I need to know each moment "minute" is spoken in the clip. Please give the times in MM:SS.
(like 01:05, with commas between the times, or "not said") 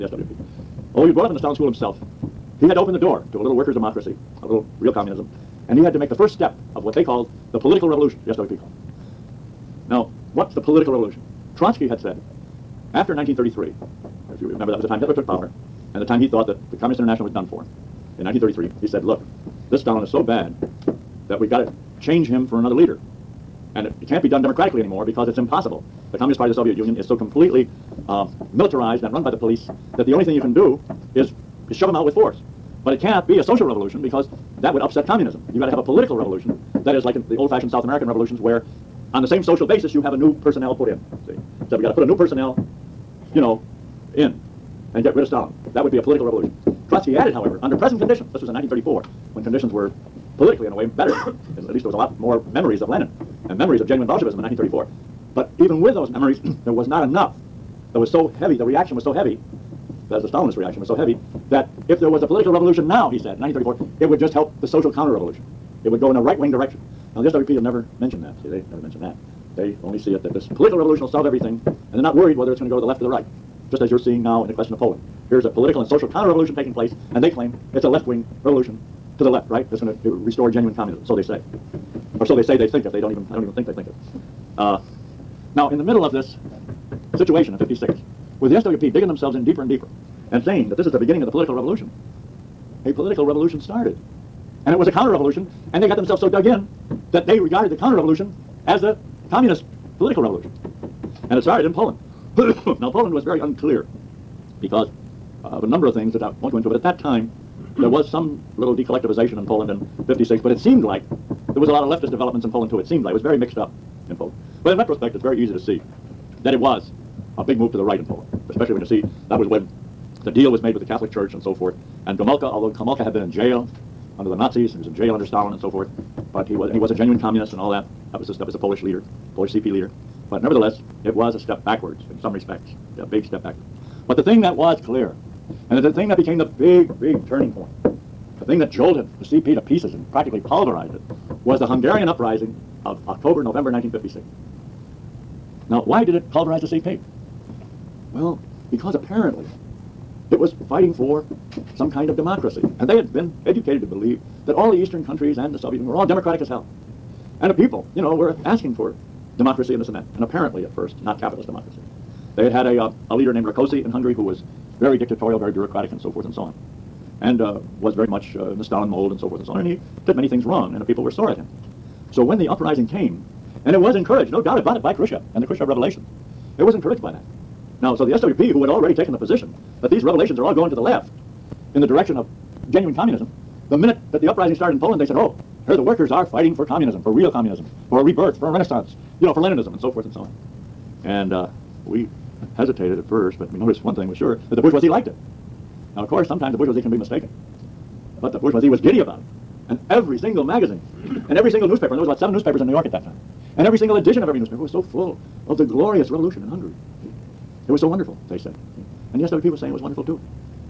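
03:03.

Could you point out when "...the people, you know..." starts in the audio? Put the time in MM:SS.
02:37.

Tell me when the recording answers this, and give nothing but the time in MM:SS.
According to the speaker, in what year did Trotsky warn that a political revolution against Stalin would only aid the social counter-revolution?
00:48.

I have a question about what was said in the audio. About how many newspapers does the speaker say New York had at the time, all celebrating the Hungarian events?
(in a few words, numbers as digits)
7.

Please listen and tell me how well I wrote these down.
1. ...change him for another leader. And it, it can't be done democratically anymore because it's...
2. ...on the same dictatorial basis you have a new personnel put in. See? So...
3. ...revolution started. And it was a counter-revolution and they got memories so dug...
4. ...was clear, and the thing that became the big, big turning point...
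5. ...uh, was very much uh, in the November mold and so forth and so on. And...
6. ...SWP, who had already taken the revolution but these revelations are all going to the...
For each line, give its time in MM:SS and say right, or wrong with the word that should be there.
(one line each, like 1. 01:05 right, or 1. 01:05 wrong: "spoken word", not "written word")
1. 00:22 right
2. 00:39 wrong: "social", not "dictatorial"
3. 01:33 wrong: "themselves", not "memories"
4. 02:14 right
5. 02:47 wrong: "Stalin", not "November"
6. 02:58 wrong: "position", not "revolution".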